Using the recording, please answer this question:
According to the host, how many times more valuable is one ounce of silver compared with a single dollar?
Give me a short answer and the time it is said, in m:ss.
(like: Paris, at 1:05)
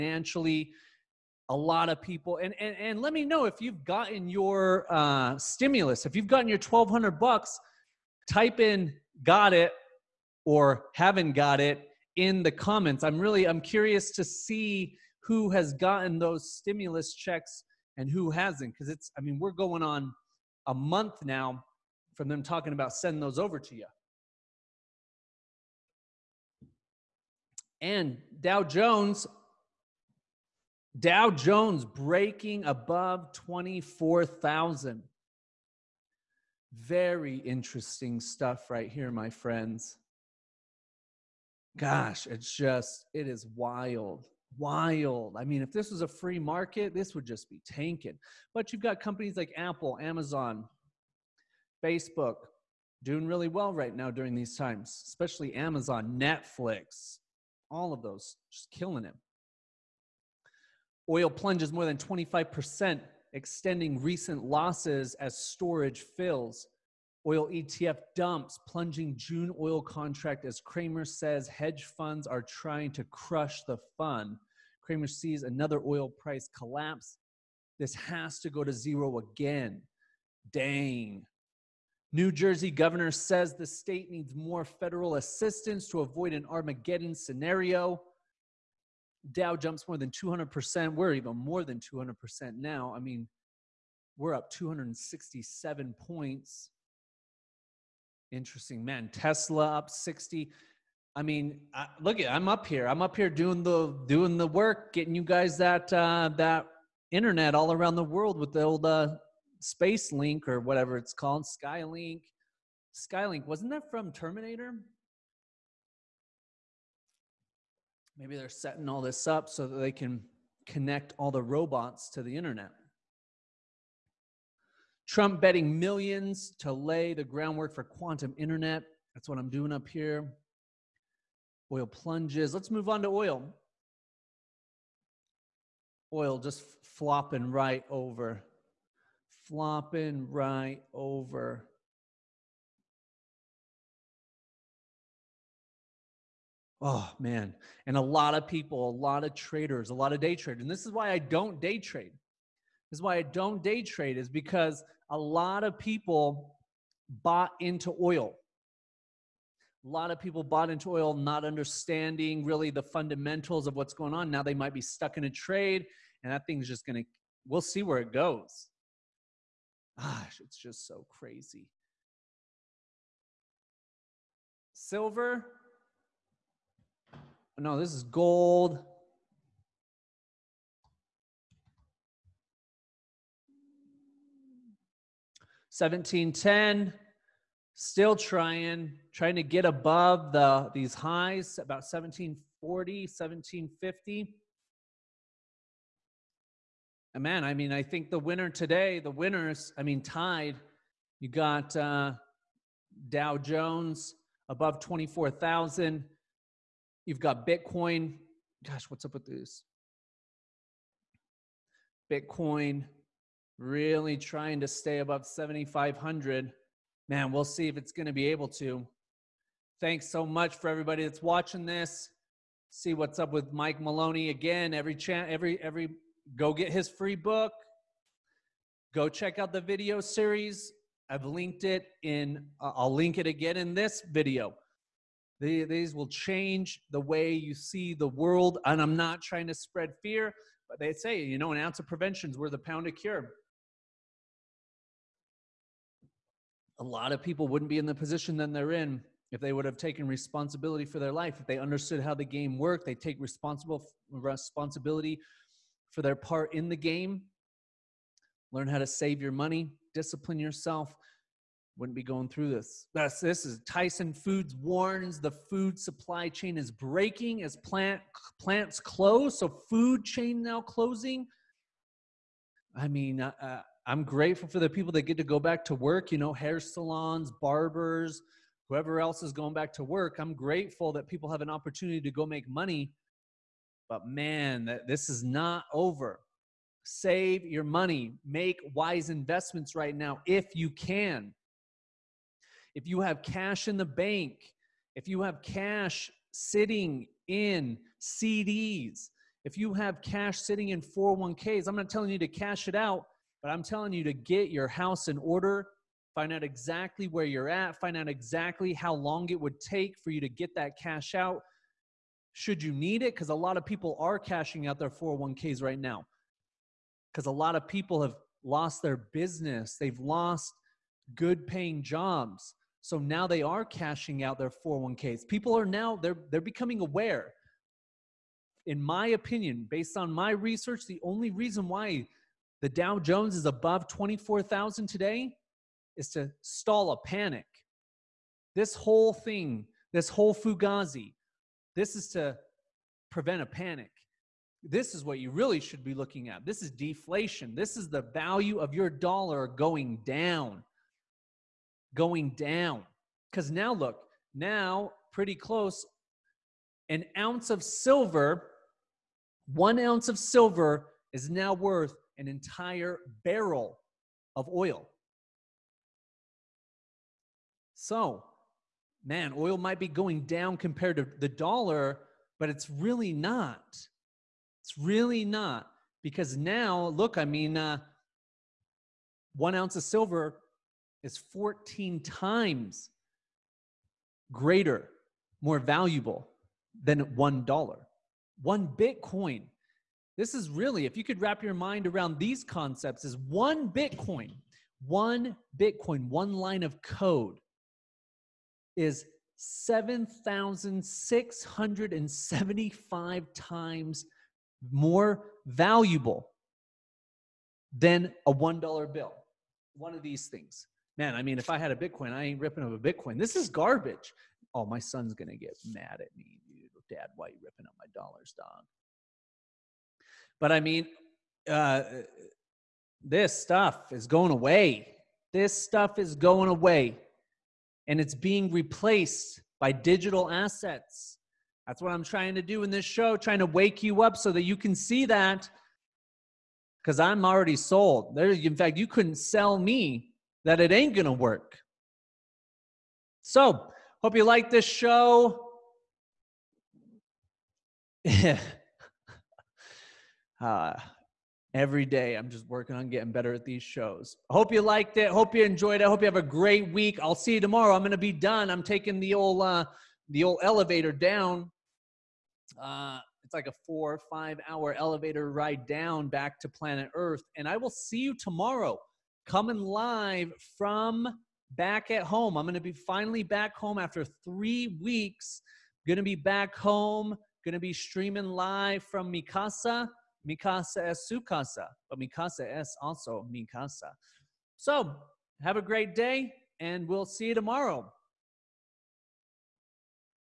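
14, at 6:21.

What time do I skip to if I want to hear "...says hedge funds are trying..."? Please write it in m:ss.
1:11.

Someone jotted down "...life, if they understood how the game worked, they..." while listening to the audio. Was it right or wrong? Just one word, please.
right.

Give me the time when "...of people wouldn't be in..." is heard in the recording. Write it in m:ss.
4:07.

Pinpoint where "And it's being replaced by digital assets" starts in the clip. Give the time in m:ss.
7:07.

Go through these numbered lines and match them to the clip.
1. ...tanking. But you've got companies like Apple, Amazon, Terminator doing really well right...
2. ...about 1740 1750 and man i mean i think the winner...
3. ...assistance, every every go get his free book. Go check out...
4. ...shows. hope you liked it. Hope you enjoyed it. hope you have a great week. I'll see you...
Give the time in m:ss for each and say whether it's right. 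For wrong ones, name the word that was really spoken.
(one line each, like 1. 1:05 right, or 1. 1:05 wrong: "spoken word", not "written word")
1. 0:47 wrong: "Facebook", not "Terminator"
2. 3:11 right
3. 3:44 wrong: "chance", not "assistance"
4. 7:33 right.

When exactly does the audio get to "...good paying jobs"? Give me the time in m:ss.
5:21.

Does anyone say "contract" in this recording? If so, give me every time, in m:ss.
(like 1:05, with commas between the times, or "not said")
1:09.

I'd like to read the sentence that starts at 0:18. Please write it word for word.
Because it's, I mean, we're going on a month now from them talking about sending those over to you.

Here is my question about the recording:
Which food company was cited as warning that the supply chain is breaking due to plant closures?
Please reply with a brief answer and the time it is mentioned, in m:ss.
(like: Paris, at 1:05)
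Tyson Foods, at 4:23.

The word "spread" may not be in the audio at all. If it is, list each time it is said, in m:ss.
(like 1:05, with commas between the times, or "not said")
3:59.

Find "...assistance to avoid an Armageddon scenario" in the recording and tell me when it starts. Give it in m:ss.
1:25.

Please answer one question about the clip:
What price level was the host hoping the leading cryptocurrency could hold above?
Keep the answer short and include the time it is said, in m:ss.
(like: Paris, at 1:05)
7,500, at 3:35.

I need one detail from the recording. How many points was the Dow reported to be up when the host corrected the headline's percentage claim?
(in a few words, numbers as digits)
267.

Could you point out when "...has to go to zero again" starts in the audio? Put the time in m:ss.
1:17.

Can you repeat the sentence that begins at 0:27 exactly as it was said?
And Dow Jones, Dow Jones breaking above 24,000.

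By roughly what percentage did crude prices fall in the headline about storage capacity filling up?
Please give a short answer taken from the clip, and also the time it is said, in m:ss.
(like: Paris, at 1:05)
25%, at 1:01.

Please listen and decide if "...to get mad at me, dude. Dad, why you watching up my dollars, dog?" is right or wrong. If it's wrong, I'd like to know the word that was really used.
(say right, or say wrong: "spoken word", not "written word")
wrong: "ripping", not "watching".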